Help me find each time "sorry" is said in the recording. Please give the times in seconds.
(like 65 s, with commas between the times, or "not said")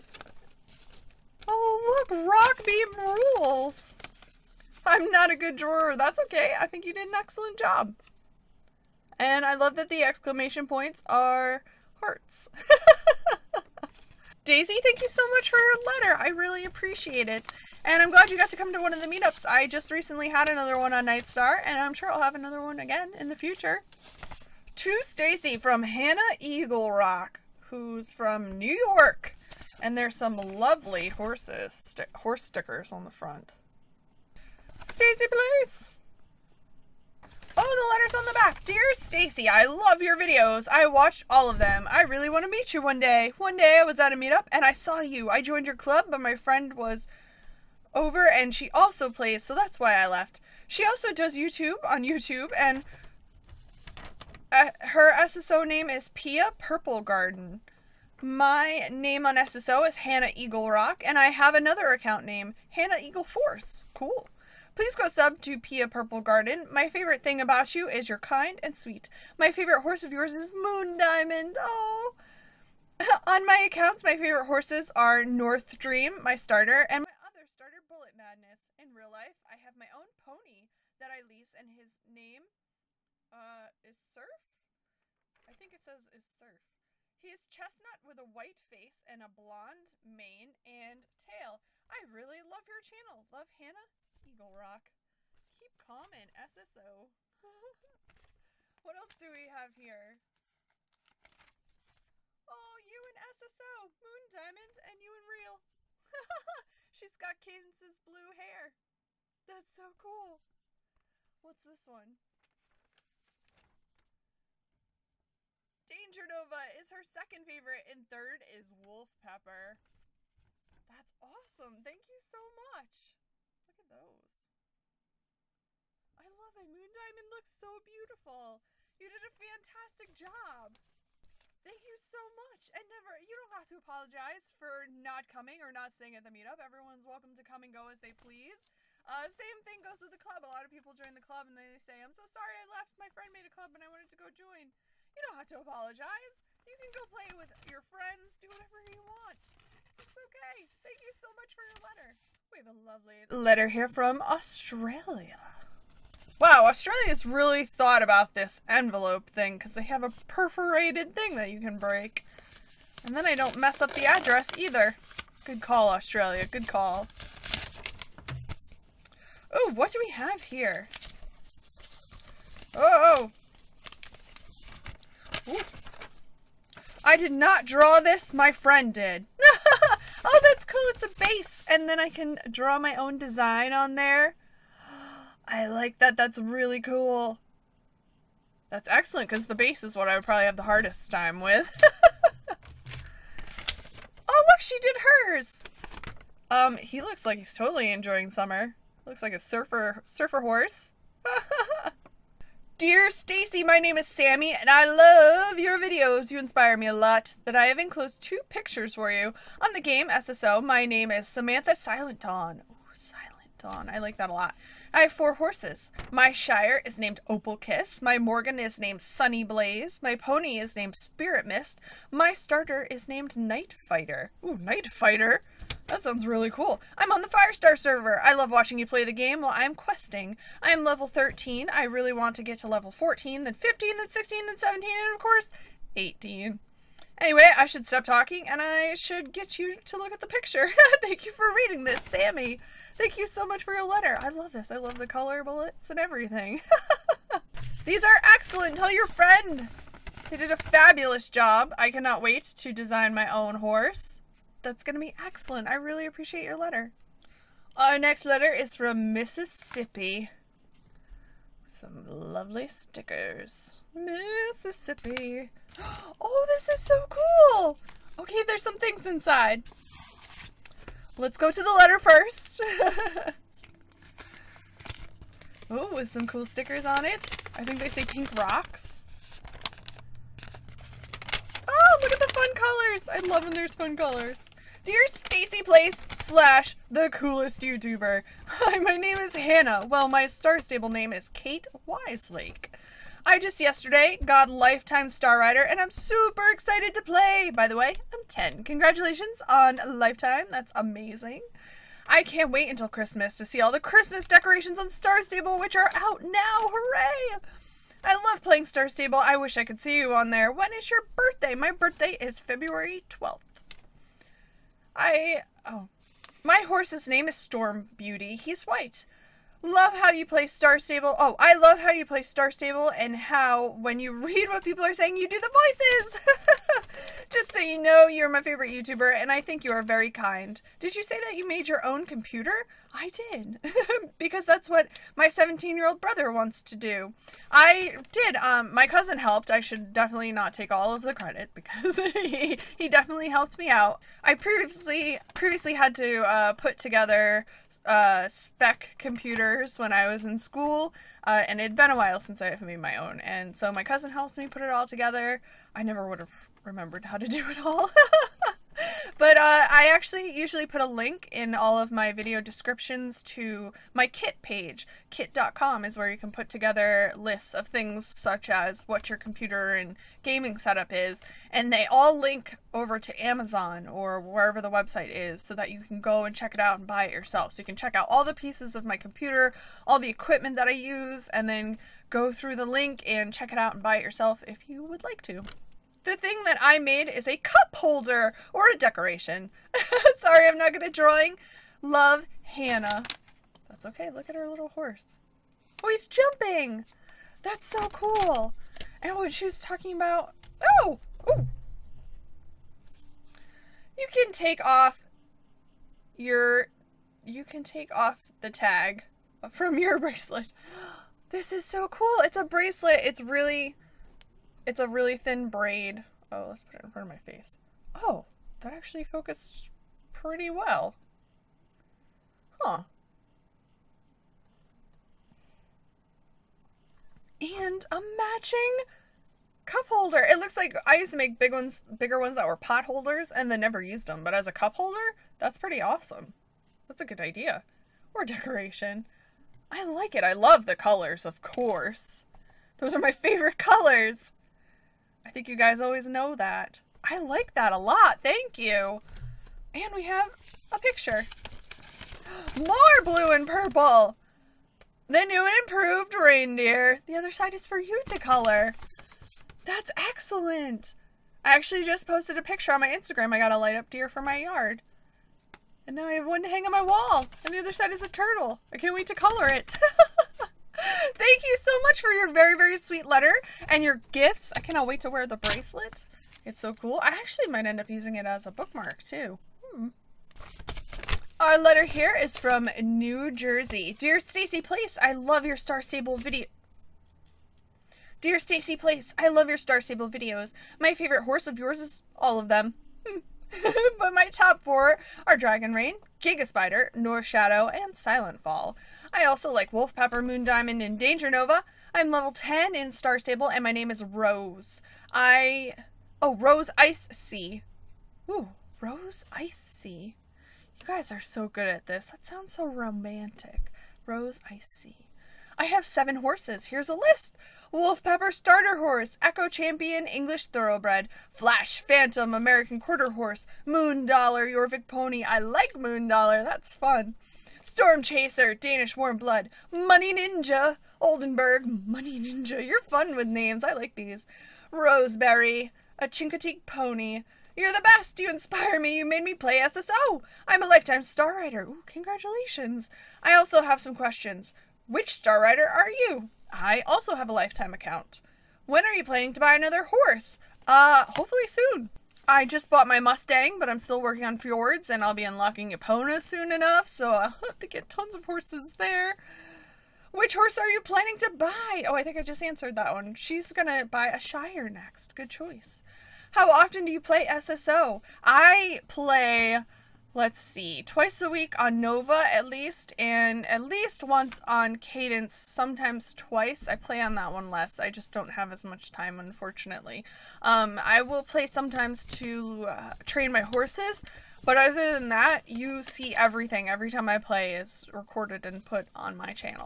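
142 s, 390 s.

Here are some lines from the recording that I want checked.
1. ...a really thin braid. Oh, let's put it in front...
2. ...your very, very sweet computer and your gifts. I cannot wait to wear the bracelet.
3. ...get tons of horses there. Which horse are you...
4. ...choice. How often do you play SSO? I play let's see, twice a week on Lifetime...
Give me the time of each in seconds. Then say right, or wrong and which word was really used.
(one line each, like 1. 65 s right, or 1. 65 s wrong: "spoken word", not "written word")
1. 414 s right
2. 472 s wrong: "letter", not "computer"
3. 557 s right
4. 565 s wrong: "Nova", not "Lifetime".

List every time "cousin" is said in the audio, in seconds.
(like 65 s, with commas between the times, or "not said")
338 s, 353 s.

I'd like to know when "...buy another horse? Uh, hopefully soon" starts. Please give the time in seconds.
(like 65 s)
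549 s.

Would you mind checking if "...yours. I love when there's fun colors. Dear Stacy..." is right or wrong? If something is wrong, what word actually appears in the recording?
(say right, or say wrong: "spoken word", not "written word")
wrong: "colors", not "yours".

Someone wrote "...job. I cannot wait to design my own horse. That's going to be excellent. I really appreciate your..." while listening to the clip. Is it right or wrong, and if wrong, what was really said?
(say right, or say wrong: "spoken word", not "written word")
right.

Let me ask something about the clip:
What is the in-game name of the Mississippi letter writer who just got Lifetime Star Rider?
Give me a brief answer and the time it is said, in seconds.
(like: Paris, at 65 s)
Kate Wiselake, at 291 s.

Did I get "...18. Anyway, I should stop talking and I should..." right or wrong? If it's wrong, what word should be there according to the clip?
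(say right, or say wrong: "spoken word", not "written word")
right.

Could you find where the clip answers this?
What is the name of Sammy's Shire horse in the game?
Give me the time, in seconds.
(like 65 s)
217 s.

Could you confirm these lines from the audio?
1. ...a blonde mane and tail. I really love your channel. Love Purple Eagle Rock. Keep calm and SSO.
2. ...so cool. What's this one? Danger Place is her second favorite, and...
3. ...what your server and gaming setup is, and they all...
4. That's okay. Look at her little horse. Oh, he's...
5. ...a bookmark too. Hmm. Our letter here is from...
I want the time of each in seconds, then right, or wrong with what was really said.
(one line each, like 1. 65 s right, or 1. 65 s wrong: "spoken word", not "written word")
1. 89 s wrong: "Hannah", not "Purple"
2. 109 s wrong: "Nova", not "Place"
3. 368 s wrong: "computer", not "server"
4. 393 s right
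5. 478 s right.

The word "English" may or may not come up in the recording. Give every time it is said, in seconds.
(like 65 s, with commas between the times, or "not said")
520 s.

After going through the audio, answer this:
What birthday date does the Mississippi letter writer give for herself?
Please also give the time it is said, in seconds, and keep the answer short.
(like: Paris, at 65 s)
February 12th, at 312 s.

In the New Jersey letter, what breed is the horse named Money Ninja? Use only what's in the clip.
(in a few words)
Oldenburg.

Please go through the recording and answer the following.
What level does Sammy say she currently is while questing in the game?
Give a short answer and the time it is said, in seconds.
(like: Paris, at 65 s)
13, at 230 s.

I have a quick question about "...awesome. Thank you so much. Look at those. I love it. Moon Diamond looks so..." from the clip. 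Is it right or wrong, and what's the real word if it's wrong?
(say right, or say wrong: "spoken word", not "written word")
right.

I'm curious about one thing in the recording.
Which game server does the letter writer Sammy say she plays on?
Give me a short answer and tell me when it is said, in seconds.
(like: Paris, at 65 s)
Firestar, at 227 s.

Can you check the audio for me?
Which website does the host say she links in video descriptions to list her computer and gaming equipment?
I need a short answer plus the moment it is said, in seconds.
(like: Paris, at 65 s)
Kit.com, at 365 s.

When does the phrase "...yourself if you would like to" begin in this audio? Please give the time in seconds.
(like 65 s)
384 s.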